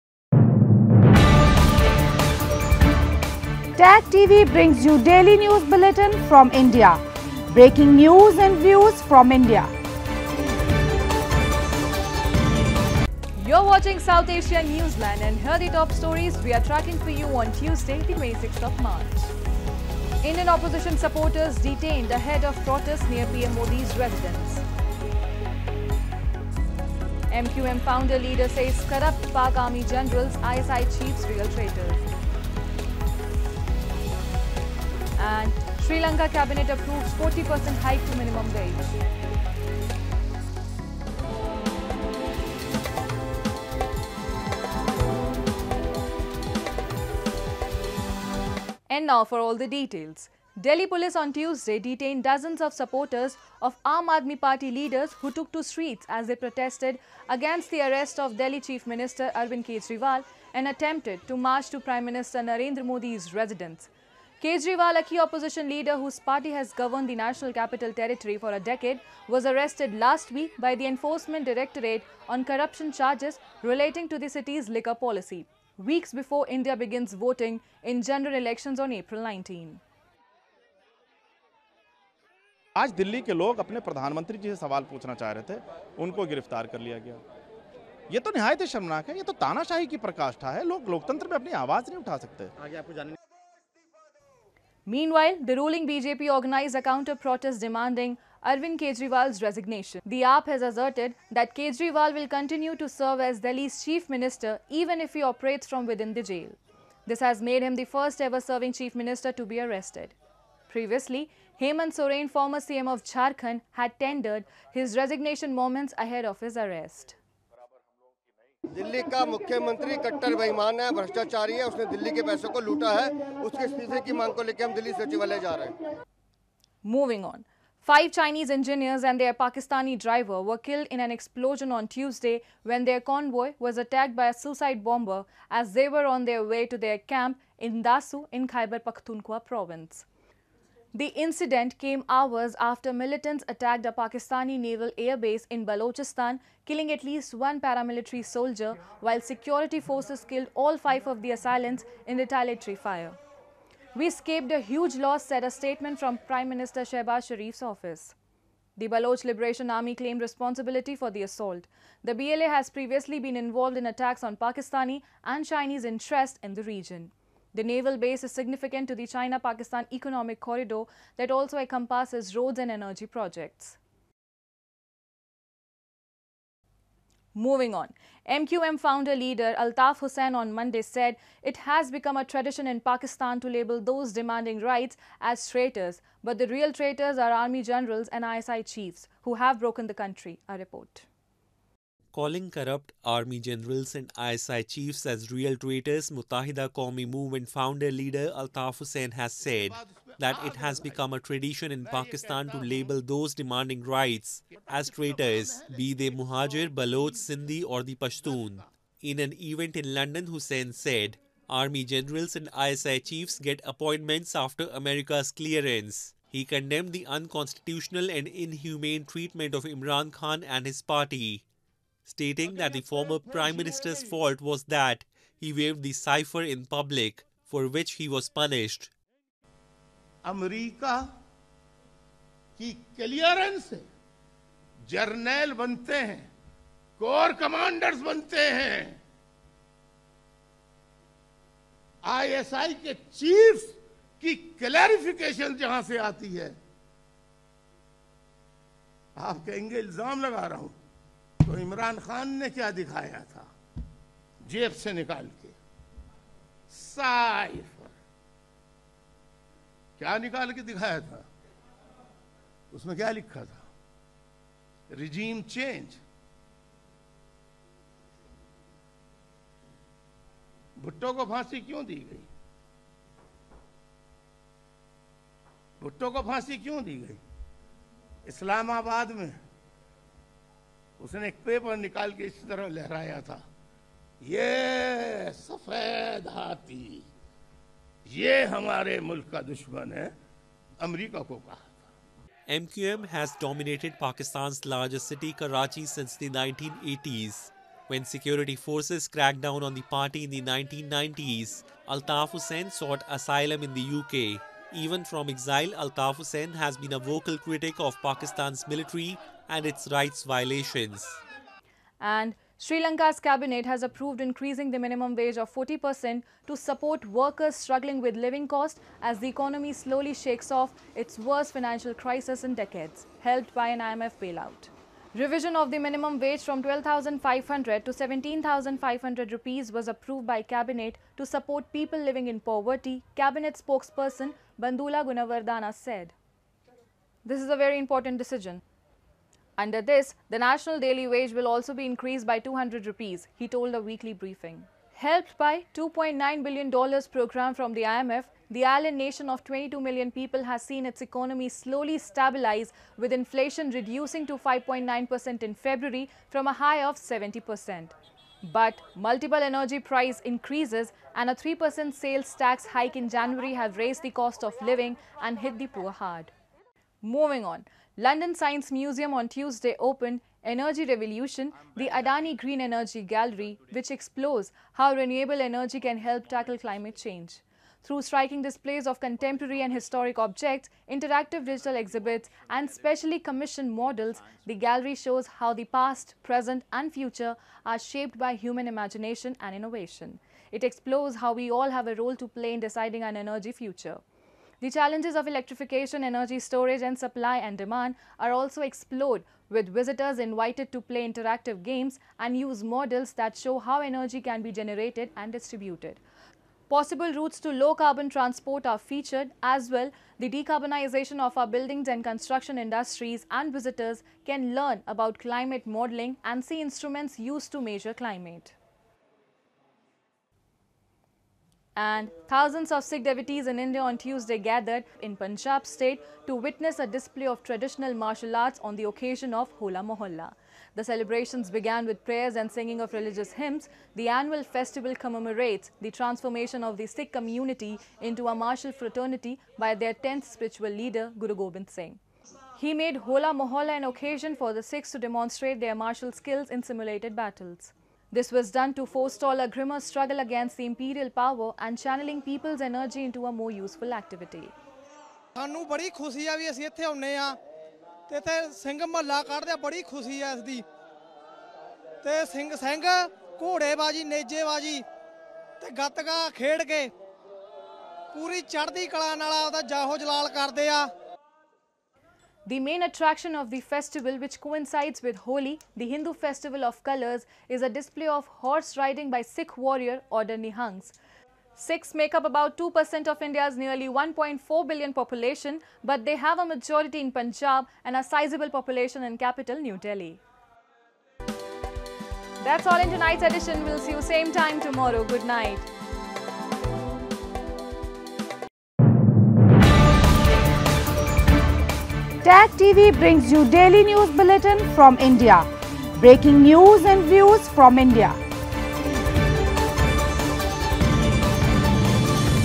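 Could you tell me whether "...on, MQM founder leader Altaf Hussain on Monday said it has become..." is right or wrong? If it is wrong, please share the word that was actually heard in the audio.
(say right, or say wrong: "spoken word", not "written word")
right.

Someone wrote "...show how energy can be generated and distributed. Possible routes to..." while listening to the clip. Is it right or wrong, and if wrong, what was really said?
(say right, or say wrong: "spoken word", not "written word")
right.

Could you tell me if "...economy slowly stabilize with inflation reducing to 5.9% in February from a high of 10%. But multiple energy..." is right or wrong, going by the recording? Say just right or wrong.
wrong.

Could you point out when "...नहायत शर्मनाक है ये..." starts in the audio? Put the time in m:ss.
1:28.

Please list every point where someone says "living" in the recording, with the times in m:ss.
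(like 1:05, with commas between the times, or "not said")
5:18, 5:31, 6:04.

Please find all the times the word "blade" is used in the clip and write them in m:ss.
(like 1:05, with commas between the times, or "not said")
not said.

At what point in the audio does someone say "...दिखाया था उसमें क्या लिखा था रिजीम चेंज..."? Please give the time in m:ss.
4:20.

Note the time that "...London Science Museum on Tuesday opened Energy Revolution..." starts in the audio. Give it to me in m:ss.
6:07.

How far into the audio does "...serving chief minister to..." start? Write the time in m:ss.
1:48.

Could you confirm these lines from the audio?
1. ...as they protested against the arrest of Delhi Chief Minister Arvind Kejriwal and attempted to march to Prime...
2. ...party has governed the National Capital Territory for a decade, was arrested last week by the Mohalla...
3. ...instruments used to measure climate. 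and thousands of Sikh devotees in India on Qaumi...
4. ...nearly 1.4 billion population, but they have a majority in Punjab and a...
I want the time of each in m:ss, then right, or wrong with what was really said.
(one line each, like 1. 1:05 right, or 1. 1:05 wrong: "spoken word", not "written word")
1. 0:56 right
2. 1:06 wrong: "Enforcement", not "Mohalla"
3. 6:56 wrong: "Tuesday", not "Qaumi"
4. 8:03 right.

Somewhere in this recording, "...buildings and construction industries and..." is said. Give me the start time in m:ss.
6:51.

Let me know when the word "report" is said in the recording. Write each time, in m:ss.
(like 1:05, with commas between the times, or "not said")
3:10.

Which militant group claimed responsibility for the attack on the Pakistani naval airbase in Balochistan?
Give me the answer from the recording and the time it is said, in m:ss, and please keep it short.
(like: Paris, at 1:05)
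Baloch Liberation Army, at 2:38.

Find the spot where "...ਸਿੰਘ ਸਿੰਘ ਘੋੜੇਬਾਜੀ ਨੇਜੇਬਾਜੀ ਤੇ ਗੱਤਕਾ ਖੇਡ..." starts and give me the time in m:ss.
7:42.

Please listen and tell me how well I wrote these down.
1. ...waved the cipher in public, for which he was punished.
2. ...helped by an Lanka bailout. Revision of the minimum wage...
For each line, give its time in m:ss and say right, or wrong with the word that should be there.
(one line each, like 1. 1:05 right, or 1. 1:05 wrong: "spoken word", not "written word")
1. 3:45 right
2. 5:23 wrong: "IMF", not "Lanka".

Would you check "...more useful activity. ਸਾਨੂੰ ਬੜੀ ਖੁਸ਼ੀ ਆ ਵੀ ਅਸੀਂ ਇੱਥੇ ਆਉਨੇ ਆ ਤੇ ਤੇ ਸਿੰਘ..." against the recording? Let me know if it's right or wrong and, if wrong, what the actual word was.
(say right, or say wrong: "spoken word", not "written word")
right.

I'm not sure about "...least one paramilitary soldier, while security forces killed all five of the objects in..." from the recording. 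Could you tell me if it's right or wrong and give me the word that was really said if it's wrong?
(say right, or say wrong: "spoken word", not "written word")
wrong: "assailants", not "objects".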